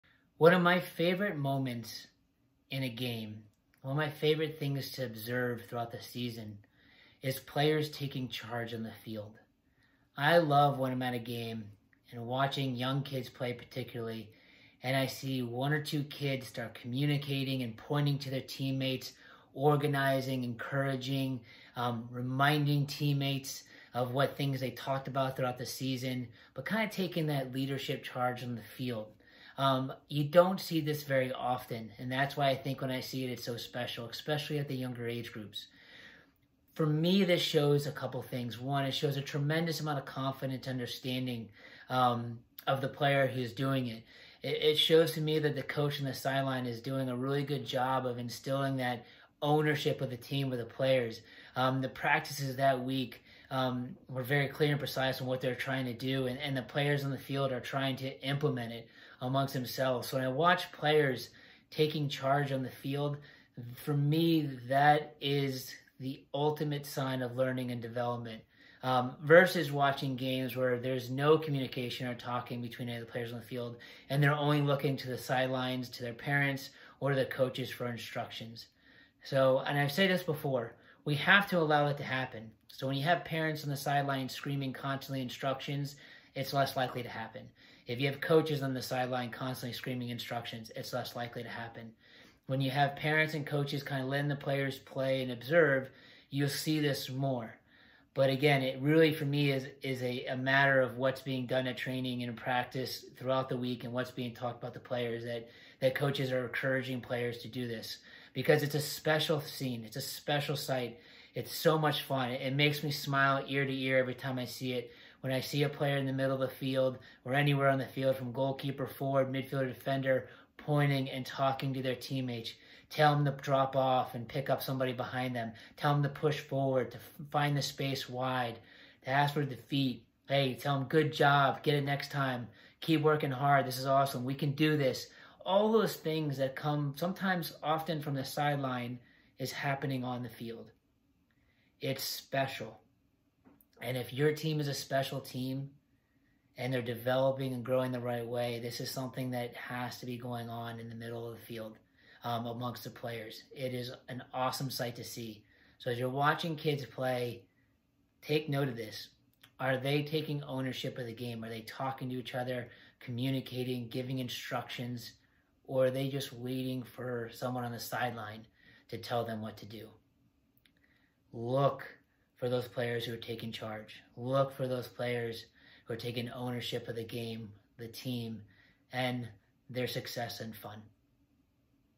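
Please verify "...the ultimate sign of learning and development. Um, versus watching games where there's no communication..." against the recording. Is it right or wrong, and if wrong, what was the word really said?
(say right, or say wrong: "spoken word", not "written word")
right.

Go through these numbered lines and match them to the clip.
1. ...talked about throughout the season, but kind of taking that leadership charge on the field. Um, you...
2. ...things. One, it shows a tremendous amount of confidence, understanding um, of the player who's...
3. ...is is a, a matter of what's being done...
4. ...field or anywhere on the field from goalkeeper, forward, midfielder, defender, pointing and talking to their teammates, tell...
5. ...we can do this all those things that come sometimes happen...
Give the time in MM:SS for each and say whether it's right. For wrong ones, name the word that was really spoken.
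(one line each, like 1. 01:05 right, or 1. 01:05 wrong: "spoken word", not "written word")
1. 00:24 right
2. 00:38 right
3. 01:39 right
4. 01:56 right
5. 02:14 wrong: "often", not "happen".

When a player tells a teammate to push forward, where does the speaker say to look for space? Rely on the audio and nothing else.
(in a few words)
Wide.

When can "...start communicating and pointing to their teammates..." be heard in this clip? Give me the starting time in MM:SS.
00:16.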